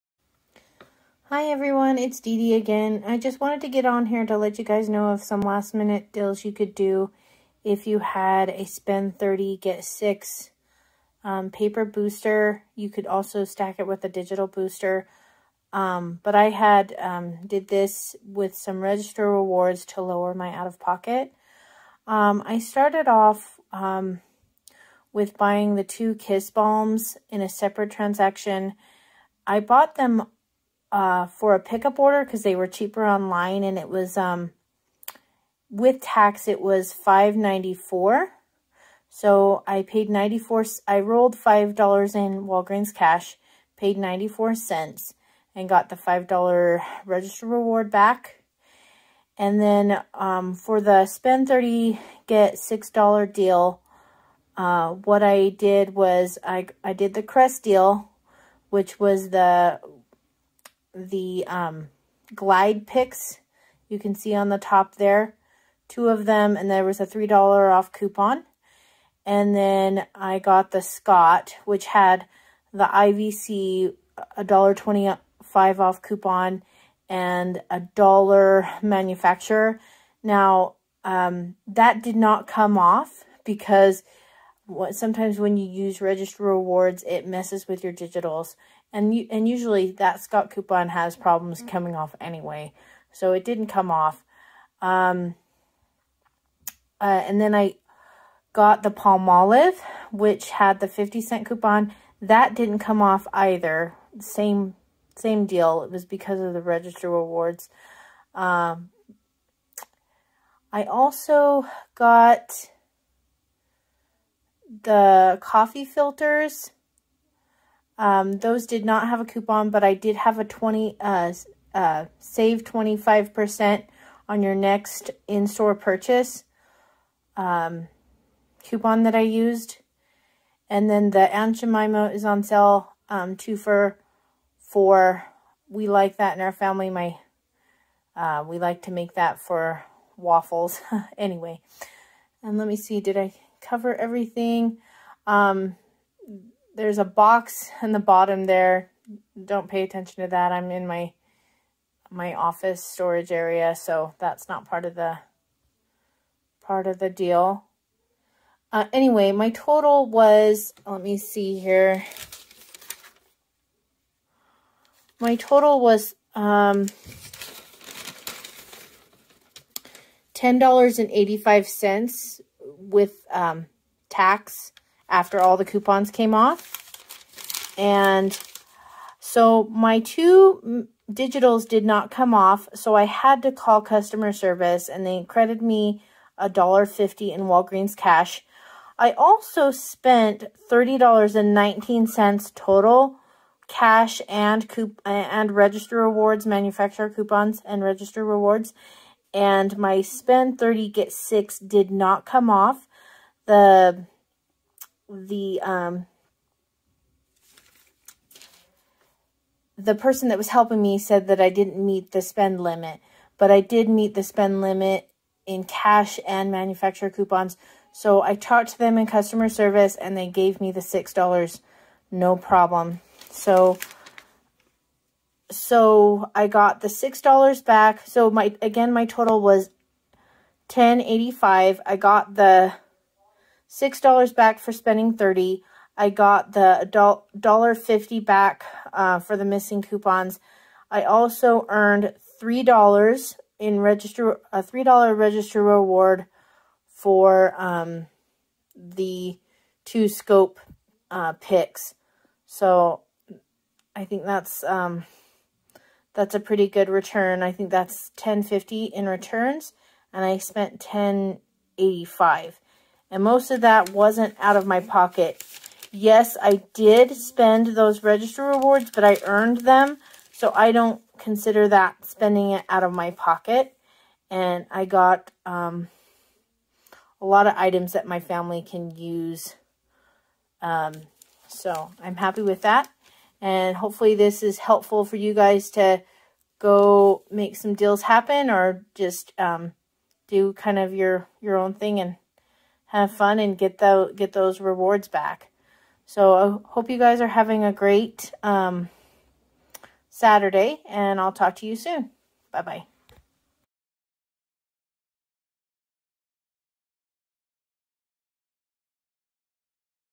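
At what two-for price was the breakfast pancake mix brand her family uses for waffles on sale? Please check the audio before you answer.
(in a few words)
2 for $4.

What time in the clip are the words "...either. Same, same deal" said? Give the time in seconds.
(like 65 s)
103 s.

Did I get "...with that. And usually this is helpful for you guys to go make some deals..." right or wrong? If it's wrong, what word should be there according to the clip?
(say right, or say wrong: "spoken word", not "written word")
wrong: "hopefully", not "usually".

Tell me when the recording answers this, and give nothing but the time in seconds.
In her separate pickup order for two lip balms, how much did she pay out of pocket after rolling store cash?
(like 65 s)
43 s.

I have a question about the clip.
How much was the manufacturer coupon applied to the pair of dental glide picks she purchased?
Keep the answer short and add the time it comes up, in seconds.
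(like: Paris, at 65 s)
$3, at 67 s.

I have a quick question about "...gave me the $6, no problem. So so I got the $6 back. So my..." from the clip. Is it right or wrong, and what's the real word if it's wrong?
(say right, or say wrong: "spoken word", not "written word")
right.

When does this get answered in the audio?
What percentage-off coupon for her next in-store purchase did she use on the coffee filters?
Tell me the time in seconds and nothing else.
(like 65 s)
122 s.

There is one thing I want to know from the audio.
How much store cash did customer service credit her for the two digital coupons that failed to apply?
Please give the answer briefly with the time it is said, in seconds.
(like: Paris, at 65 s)
$1.50, at 186 s.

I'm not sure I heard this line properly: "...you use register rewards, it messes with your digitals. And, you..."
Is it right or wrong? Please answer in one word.
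right.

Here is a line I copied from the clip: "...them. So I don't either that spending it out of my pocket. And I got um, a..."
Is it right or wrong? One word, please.
wrong.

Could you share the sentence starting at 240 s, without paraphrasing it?
I also earned three dollars in register a three dollar register reward for um, the two scope uh, picks.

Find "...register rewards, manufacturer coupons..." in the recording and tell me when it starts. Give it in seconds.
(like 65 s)
195 s.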